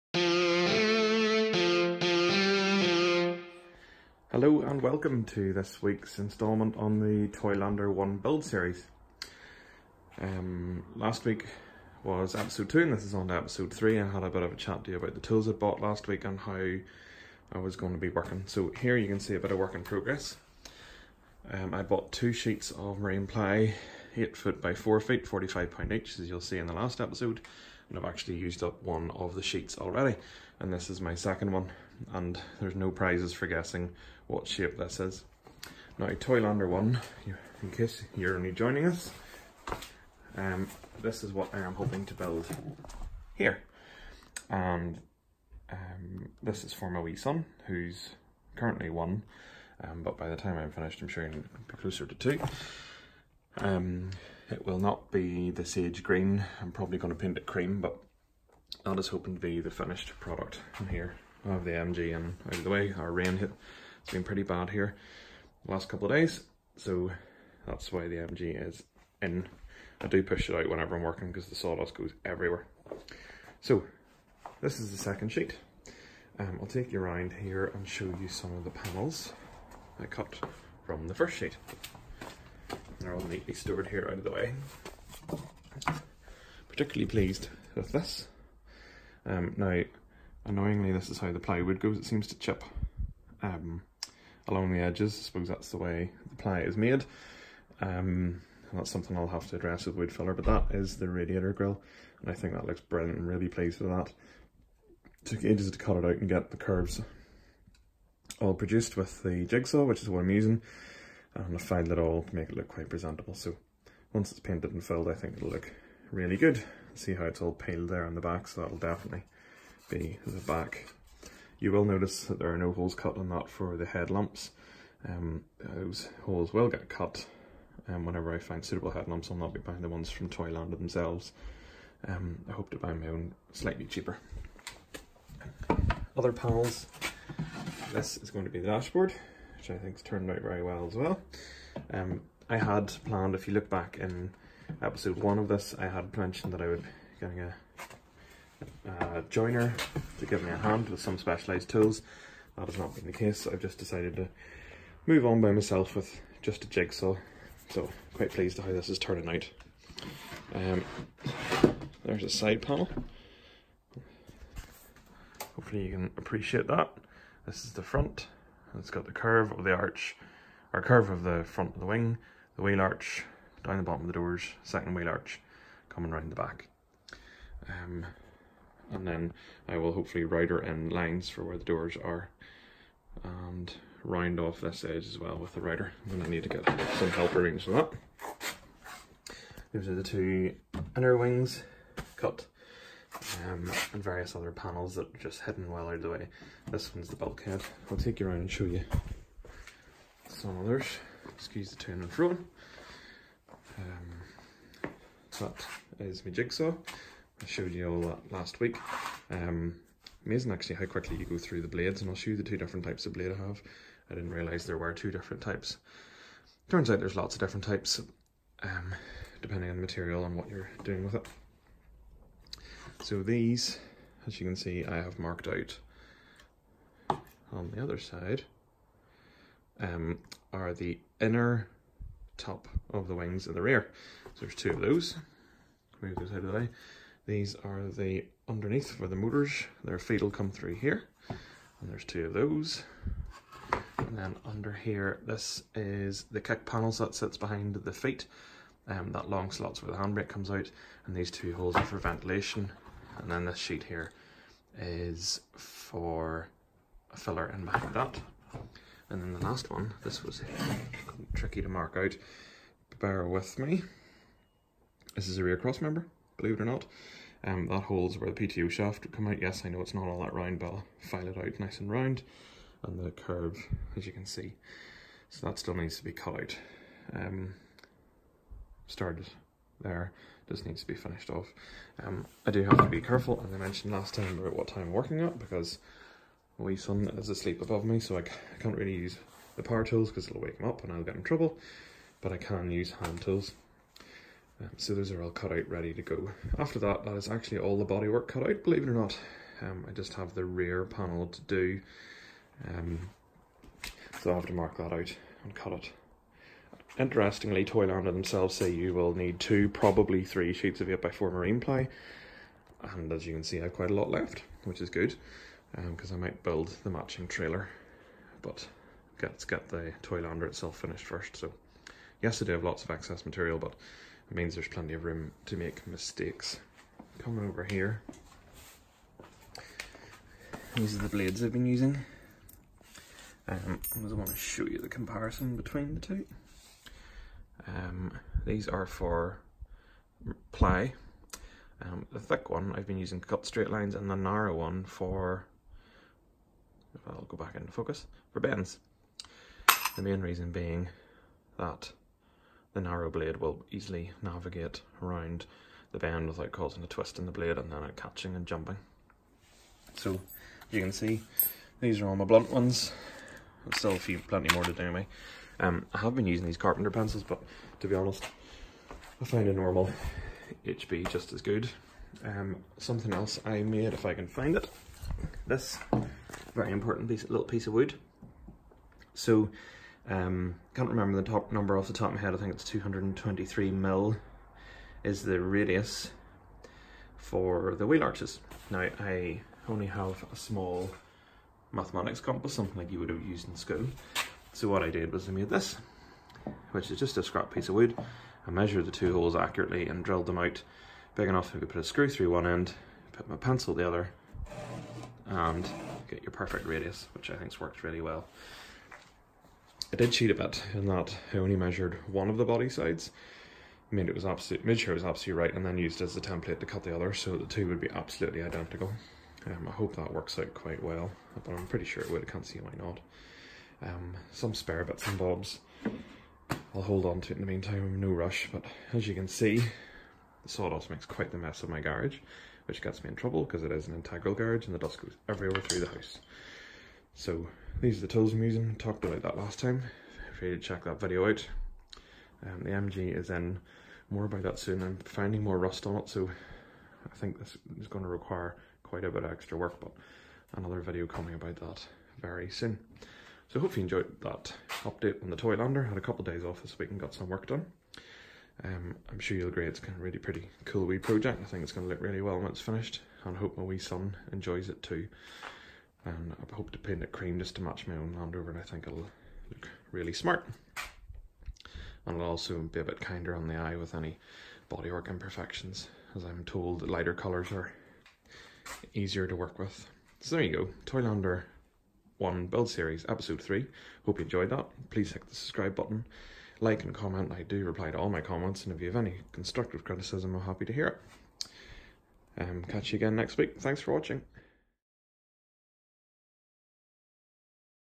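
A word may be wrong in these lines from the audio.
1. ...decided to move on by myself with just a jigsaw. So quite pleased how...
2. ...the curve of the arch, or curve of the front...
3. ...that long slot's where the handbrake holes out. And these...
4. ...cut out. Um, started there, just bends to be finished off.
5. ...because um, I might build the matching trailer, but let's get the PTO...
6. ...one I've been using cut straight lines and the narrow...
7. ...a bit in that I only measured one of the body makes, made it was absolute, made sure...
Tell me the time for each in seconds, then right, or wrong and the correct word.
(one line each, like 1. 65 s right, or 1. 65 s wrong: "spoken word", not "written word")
1. 153 s right
2. 169 s right
3. 249 s wrong: "comes", not "holes"
4. 276 s wrong: "needs", not "bends"
5. 315 s wrong: "Toylander", not "PTO"
6. 342 s right
7. 410 s wrong: "sides", not "makes".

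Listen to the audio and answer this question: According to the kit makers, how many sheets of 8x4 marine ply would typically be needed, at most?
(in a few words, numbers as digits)
3.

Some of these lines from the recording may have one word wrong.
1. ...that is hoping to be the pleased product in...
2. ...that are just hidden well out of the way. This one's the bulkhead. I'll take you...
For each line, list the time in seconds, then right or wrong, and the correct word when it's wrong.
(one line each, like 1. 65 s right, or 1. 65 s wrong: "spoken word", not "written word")
1. 58 s wrong: "finished", not "pleased"
2. 194 s right.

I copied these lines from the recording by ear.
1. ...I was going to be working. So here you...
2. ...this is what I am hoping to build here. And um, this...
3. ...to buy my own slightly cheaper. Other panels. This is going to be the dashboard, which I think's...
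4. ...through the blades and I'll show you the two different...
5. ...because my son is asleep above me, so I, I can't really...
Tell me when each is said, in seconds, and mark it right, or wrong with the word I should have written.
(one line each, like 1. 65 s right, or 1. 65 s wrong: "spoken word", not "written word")
1. 17 s right
2. 41 s right
3. 132 s right
4. 211 s right
5. 285 s right.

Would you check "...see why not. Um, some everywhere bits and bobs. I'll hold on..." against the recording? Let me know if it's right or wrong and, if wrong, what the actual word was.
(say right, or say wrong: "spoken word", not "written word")
wrong: "spare", not "everywhere".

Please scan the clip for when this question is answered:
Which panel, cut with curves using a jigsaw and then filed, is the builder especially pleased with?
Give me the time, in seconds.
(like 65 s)
101 s.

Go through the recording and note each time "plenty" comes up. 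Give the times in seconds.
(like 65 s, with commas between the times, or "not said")
324 s, 364 s.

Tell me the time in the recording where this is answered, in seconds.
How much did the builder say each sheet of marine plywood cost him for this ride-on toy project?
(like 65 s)
25 s.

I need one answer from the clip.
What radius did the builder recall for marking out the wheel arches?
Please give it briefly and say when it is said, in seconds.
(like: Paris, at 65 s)
223 mm, at 382 s.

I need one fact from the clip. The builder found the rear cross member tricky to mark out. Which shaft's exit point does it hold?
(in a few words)
PTO shaft.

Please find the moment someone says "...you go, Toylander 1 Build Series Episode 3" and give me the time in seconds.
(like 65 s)
480 s.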